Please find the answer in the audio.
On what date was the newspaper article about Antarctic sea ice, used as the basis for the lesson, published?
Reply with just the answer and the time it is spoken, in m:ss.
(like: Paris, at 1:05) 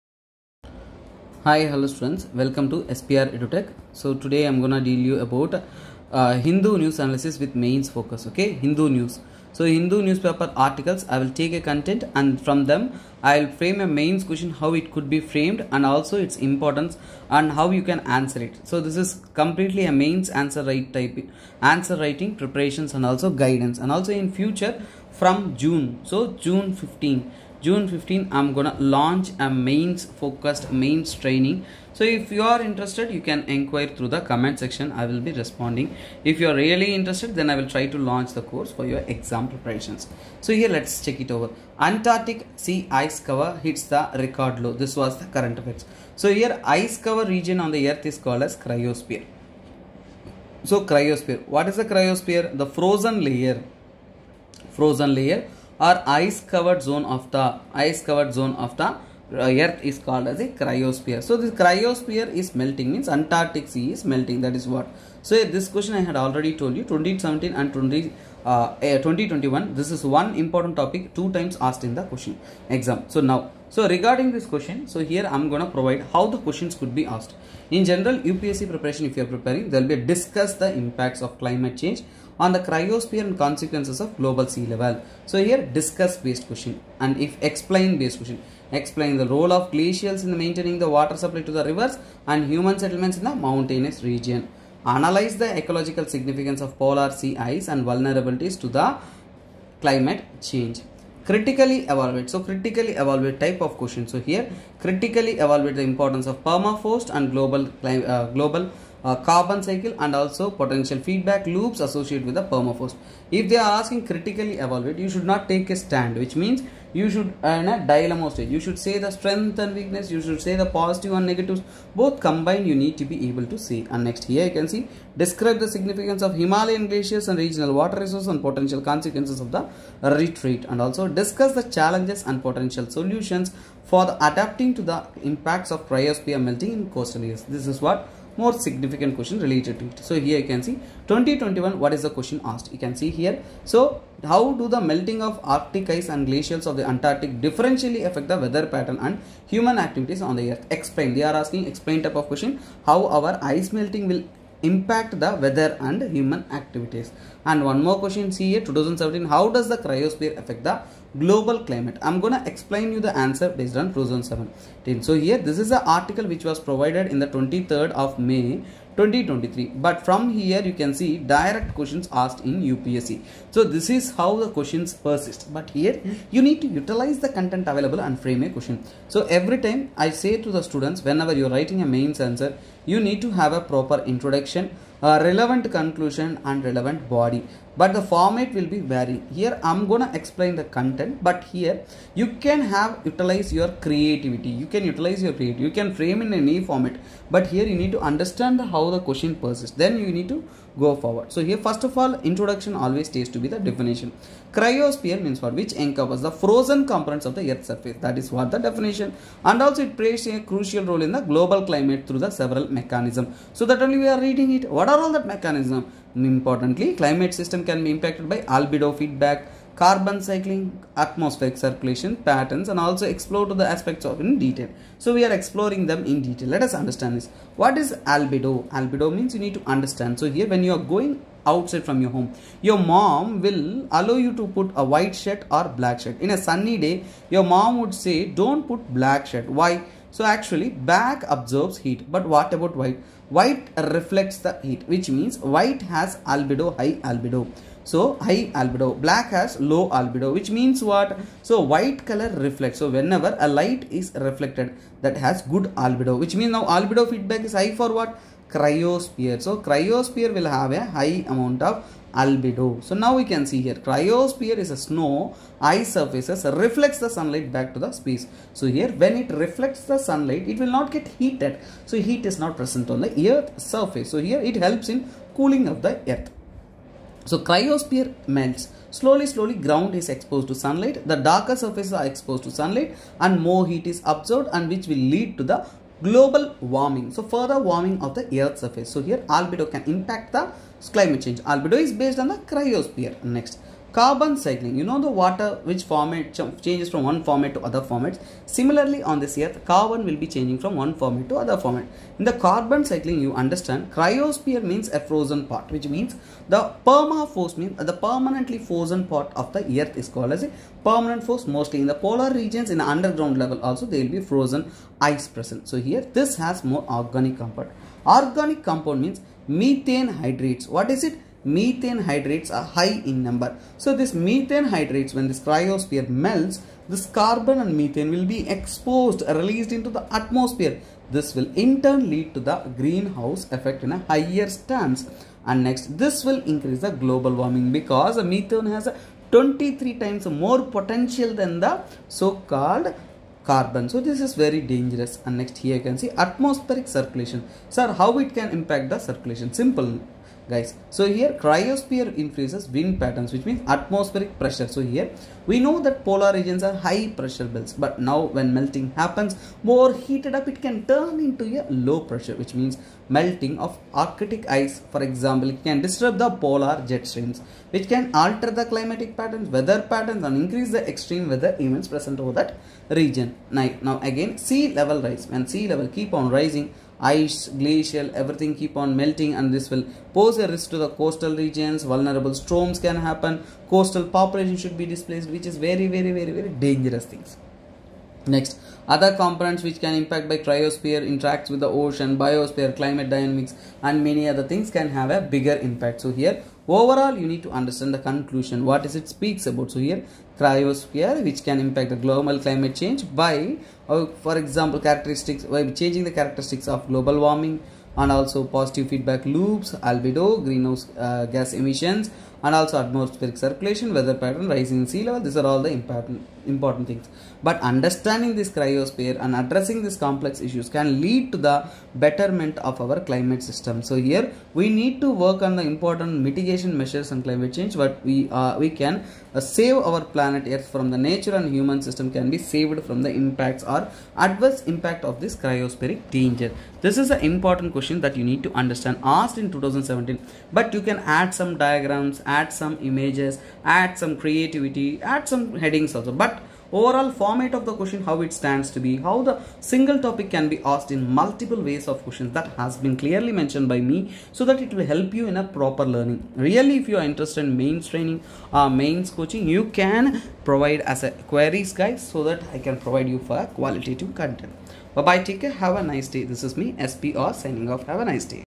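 23 May 2023, at 2:47.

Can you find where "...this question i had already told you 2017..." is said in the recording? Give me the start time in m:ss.
1:05.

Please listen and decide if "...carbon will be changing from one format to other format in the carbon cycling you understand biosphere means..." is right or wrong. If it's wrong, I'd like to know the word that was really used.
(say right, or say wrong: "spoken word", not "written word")
wrong: "cryosphere", not "biosphere".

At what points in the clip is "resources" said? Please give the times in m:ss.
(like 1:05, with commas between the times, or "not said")
2:07.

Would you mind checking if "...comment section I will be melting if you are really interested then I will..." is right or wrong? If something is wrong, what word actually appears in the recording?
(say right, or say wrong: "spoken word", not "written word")
wrong: "responding", not "melting".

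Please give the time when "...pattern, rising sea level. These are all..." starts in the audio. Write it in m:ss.
6:54.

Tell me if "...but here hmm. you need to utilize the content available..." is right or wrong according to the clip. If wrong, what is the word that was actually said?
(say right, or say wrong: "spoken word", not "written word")
right.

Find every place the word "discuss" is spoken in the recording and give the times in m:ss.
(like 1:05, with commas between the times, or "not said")
1:19, 1:25, 2:11.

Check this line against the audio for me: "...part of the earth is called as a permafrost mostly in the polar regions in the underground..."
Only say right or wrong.
right.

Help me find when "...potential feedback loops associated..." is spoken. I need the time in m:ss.
1:50.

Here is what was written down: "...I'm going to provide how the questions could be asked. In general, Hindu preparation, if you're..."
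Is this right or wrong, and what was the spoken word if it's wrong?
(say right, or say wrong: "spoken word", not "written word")
wrong: "UPSC", not "Hindu".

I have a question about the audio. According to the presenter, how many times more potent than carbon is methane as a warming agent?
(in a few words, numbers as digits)
23.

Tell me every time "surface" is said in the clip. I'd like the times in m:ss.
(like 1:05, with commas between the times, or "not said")
3:27, 4:25, 4:33, 4:41, 4:48.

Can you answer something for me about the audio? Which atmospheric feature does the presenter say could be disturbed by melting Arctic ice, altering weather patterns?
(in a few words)
polar jet streams.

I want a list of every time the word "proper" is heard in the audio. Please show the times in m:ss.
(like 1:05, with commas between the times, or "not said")
3:03, 7:35.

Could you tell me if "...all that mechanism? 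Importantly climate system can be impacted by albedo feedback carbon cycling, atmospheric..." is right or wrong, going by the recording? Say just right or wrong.
right.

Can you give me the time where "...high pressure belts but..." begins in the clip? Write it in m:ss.
5:56.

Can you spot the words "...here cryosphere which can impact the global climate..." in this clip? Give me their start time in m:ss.
6:39.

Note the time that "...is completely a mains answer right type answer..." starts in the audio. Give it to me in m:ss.
0:18.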